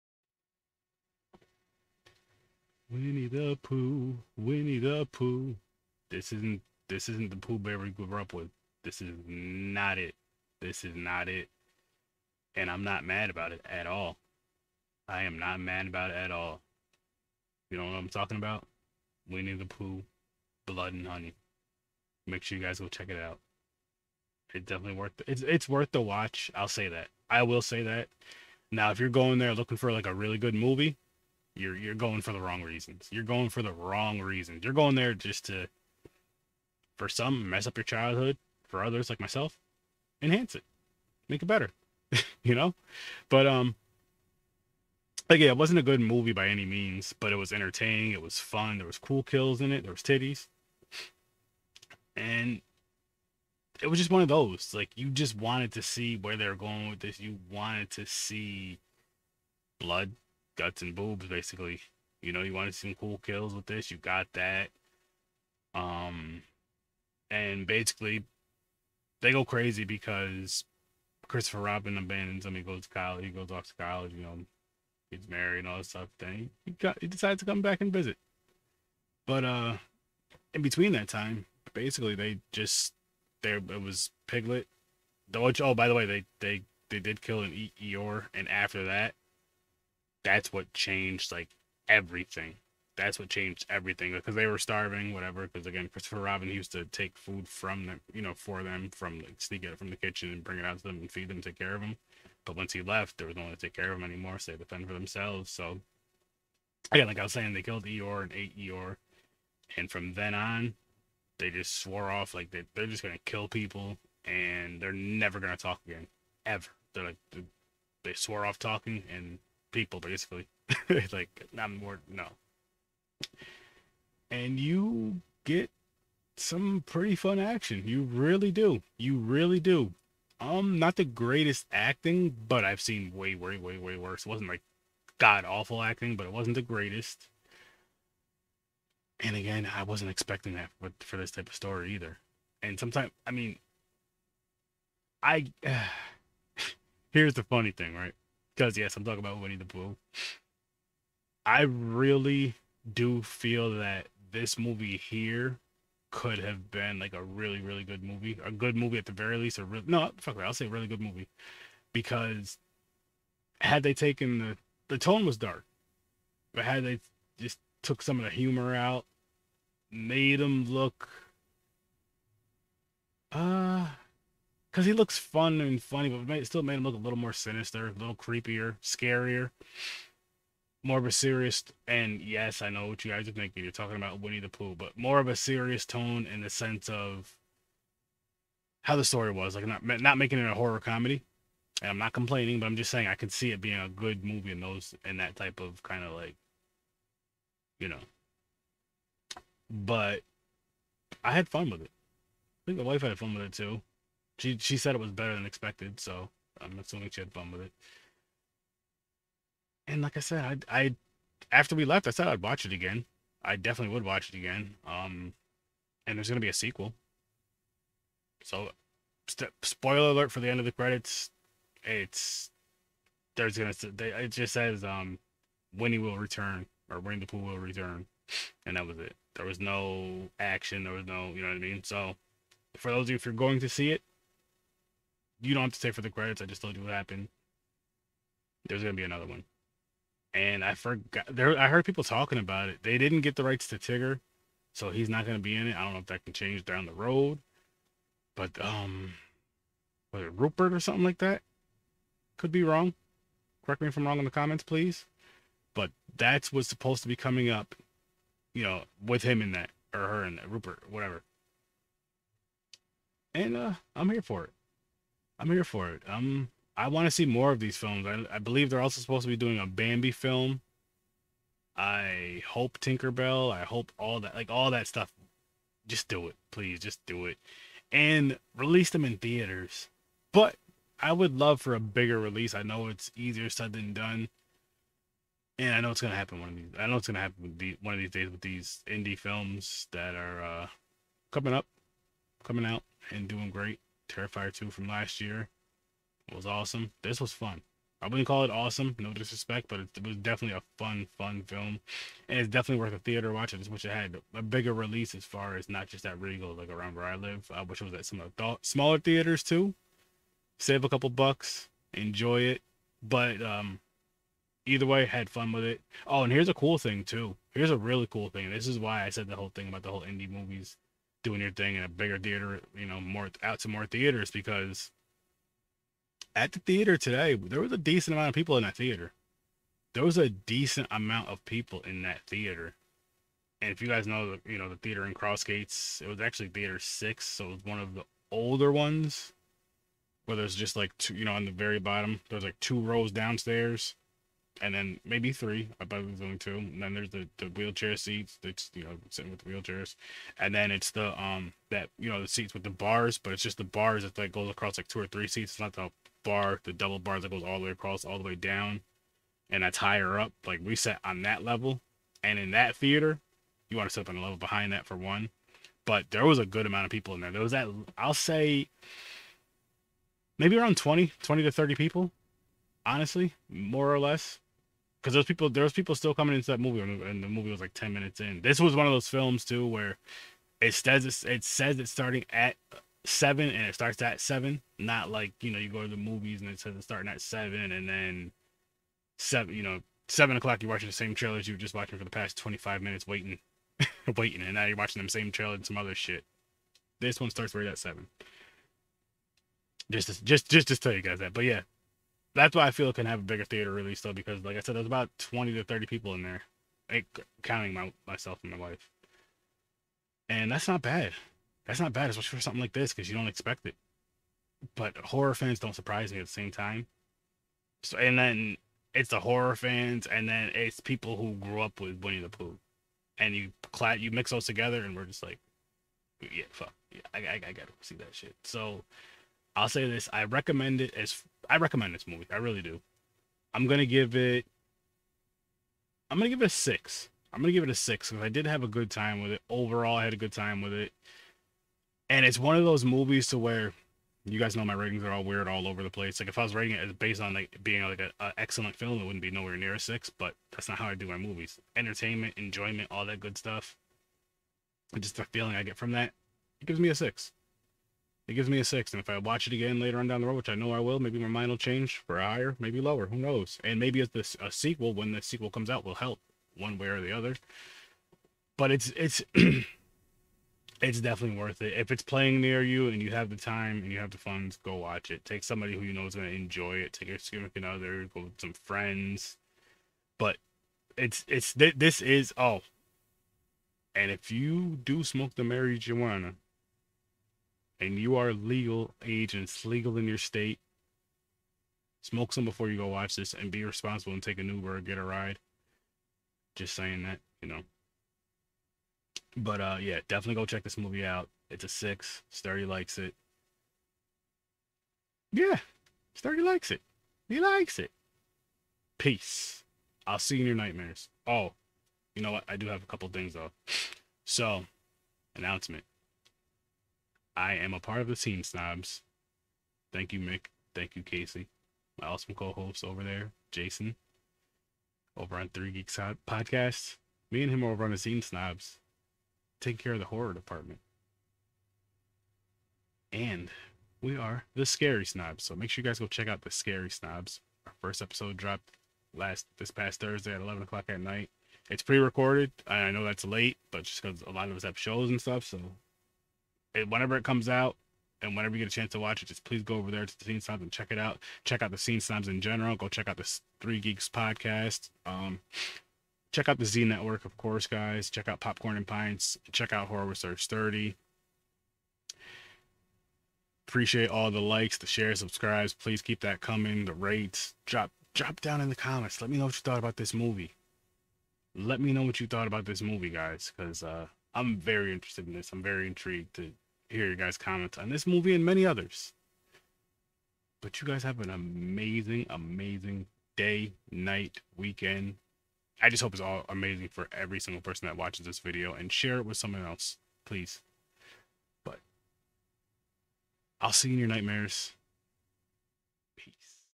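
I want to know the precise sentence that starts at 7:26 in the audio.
Like if I was rating it based on like being like an excellent film, it wouldn't be nowhere near a six.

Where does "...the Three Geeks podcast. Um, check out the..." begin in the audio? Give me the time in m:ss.
9:13.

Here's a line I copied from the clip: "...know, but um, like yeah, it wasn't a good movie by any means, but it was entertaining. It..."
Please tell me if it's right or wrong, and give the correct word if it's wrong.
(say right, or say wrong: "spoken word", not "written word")
right.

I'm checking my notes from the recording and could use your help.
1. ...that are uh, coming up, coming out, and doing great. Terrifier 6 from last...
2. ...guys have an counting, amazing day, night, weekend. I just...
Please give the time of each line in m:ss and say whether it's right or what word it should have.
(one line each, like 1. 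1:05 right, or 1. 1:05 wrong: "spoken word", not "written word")
1. 4:49 wrong: "2", not "6"
2. 9:40 wrong: "amazing", not "counting".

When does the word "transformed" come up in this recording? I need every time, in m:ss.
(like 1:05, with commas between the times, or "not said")
not said.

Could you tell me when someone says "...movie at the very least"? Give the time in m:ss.
2:38.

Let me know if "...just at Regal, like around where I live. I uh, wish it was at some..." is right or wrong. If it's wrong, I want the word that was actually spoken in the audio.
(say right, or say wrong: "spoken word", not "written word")
right.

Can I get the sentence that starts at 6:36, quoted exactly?
This one starts right at seven.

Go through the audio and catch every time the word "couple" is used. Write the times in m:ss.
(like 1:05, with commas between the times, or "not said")
5:10, 8:32.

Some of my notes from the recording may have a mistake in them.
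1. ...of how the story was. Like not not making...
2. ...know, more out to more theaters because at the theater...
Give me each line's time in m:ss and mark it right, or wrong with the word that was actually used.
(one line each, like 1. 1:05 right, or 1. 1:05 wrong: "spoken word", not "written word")
1. 3:06 right
2. 5:22 right.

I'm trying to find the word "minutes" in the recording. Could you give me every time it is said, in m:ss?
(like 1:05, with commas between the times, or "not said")
6:17, 6:32.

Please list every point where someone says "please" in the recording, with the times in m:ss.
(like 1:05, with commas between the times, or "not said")
4:14, 4:36, 9:09, 9:25, 9:50.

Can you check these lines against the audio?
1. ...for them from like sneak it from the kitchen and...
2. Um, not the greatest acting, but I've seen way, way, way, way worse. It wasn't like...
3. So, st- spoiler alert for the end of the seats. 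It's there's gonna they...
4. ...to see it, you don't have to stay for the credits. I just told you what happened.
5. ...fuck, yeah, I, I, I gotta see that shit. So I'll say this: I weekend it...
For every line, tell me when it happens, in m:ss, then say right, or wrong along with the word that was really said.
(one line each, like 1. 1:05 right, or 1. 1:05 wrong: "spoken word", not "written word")
1. 1:38 right
2. 2:10 right
3. 3:38 wrong: "credits", not "seats"
4. 3:53 right
5. 7:06 wrong: "recommend", not "weekend".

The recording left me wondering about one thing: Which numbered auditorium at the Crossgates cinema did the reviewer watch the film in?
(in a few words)
6.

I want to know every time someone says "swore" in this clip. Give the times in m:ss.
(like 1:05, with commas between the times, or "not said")
1:51, 1:58.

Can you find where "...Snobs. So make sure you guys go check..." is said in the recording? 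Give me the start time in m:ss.
8:55.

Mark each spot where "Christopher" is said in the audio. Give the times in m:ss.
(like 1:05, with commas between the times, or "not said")
1:11, 1:35.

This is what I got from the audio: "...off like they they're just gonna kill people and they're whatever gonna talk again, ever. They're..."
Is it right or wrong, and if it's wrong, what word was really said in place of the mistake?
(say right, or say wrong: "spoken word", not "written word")
wrong: "never", not "whatever".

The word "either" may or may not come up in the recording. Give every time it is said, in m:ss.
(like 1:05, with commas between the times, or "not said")
2:21, 5:14.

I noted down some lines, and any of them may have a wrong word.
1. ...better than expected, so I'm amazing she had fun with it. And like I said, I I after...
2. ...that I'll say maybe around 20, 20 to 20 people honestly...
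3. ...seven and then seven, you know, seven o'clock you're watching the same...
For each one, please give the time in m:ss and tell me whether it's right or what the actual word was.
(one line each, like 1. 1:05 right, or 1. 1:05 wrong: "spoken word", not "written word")
1. 3:25 wrong: "assuming", not "amazing"
2. 6:07 wrong: "30", not "20"
3. 6:27 right.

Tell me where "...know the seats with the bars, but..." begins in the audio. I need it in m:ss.
5:52.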